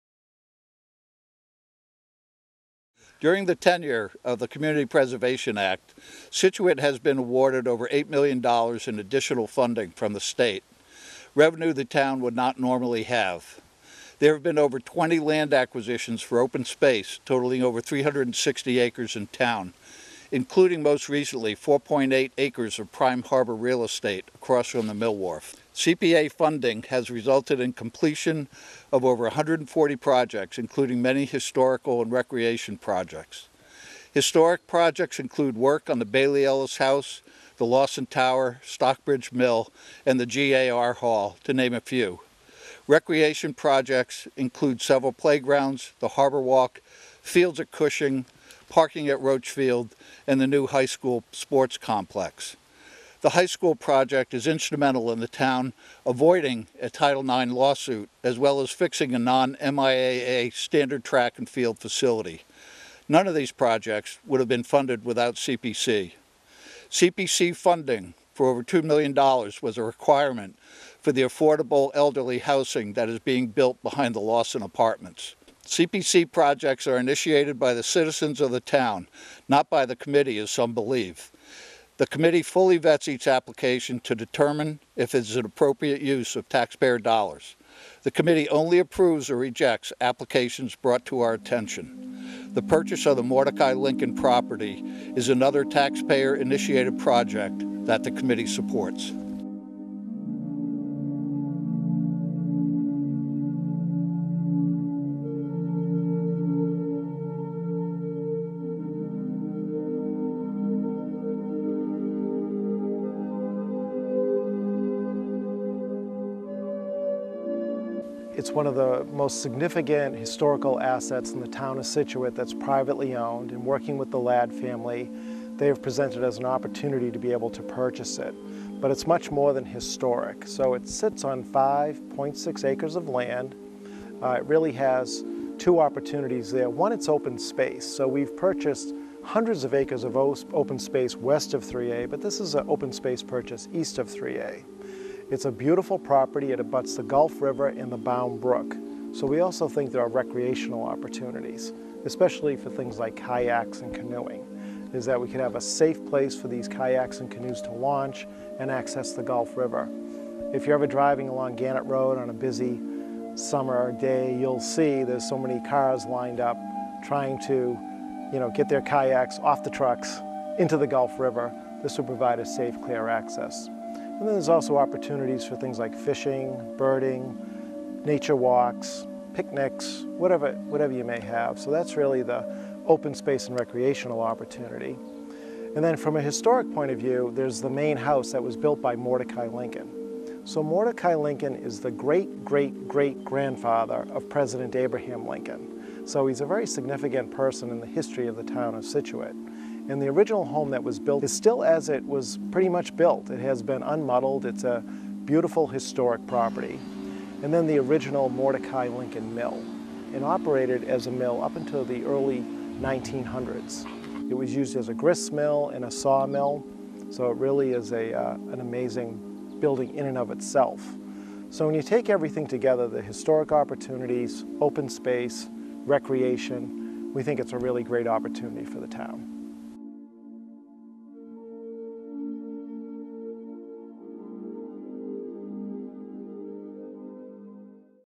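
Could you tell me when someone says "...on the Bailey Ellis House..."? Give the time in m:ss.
0:35.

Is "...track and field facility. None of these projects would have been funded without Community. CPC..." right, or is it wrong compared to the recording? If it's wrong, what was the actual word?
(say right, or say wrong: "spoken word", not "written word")
wrong: "CPC", not "Community".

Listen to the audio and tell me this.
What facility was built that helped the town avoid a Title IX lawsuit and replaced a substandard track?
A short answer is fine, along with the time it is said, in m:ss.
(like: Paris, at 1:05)
high school sports complex, at 0:50.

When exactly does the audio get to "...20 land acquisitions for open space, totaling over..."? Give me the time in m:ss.
0:14.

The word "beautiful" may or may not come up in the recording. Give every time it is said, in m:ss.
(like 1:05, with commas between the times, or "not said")
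2:25, 3:25.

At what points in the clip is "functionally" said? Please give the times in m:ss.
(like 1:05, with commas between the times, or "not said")
not said.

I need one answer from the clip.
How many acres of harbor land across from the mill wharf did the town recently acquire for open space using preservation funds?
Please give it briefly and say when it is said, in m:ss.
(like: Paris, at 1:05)
4.8 acres, at 0:21.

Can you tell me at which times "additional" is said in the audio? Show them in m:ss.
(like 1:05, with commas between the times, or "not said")
0:08.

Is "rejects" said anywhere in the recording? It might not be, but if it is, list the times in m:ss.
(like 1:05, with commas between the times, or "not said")
1:29.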